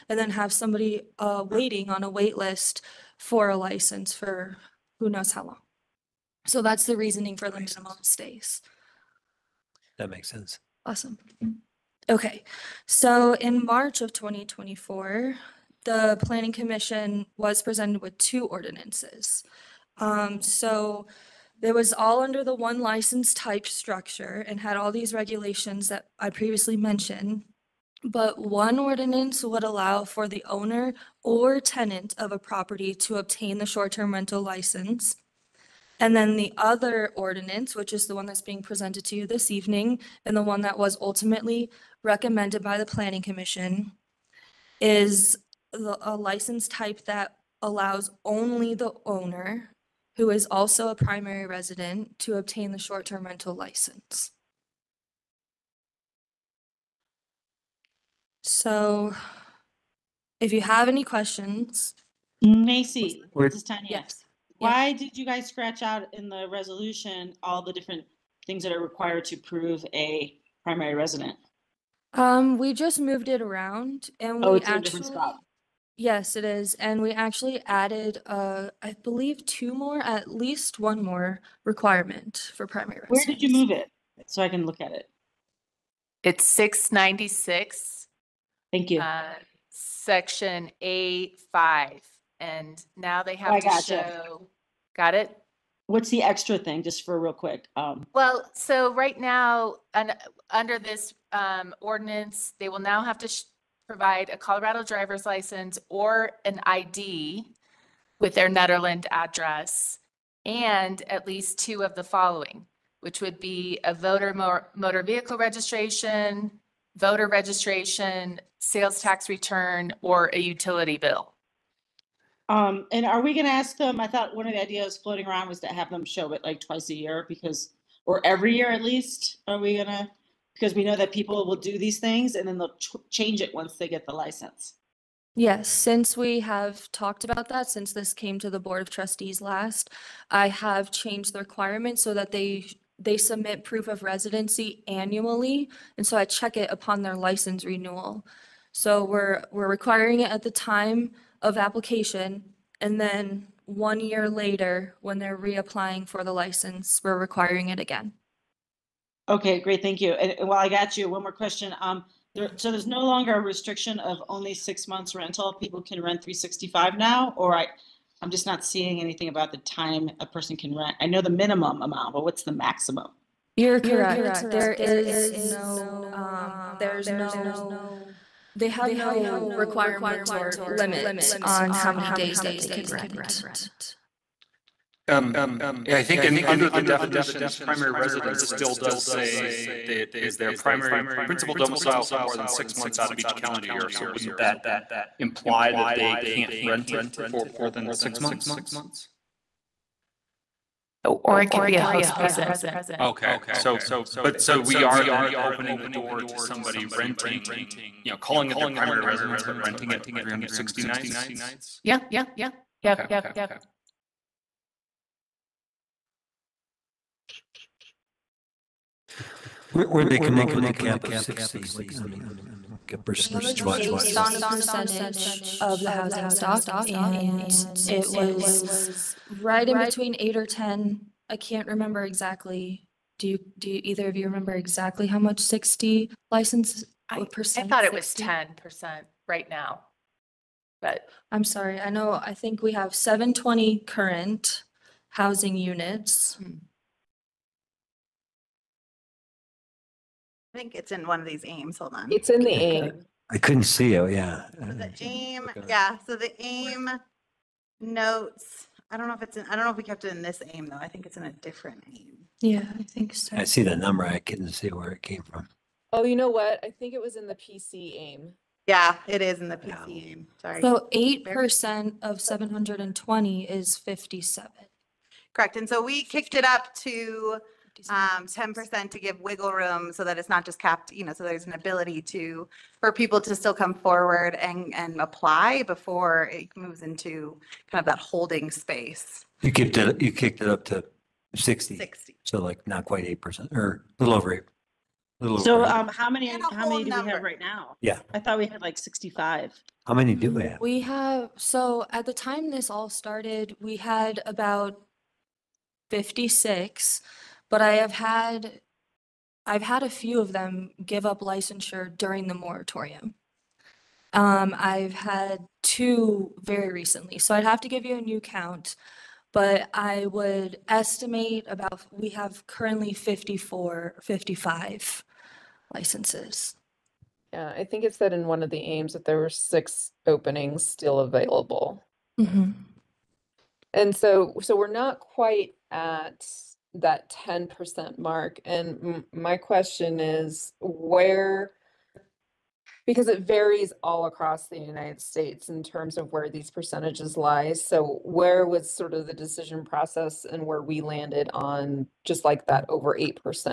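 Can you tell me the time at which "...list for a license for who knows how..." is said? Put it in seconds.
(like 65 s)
2 s.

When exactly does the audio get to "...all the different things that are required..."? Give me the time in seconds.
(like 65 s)
67 s.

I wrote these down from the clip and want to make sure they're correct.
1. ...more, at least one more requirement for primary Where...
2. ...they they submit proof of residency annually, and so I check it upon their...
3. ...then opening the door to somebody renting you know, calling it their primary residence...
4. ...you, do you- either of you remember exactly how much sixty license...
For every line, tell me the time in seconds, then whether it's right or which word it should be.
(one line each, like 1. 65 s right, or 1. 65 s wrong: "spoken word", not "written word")
1. 79 s right
2. 142 s right
3. 205 s right
4. 233 s right.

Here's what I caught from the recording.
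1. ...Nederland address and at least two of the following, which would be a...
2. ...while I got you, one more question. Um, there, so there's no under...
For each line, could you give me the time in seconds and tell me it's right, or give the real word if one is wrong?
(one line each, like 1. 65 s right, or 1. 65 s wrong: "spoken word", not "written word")
1. 108 s right
2. 160 s wrong: "longer", not "under".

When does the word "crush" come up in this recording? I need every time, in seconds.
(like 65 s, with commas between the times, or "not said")
not said.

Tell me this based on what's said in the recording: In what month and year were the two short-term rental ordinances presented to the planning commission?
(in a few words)
March 2024.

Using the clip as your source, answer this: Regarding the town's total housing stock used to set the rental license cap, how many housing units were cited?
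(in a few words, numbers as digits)
720.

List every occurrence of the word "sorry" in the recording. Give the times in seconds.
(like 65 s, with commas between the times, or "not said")
241 s, 270 s.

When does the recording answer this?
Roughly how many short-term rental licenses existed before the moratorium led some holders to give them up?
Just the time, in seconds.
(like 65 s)
304 s.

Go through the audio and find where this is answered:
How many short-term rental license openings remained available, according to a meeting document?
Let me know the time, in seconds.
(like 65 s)
329 s.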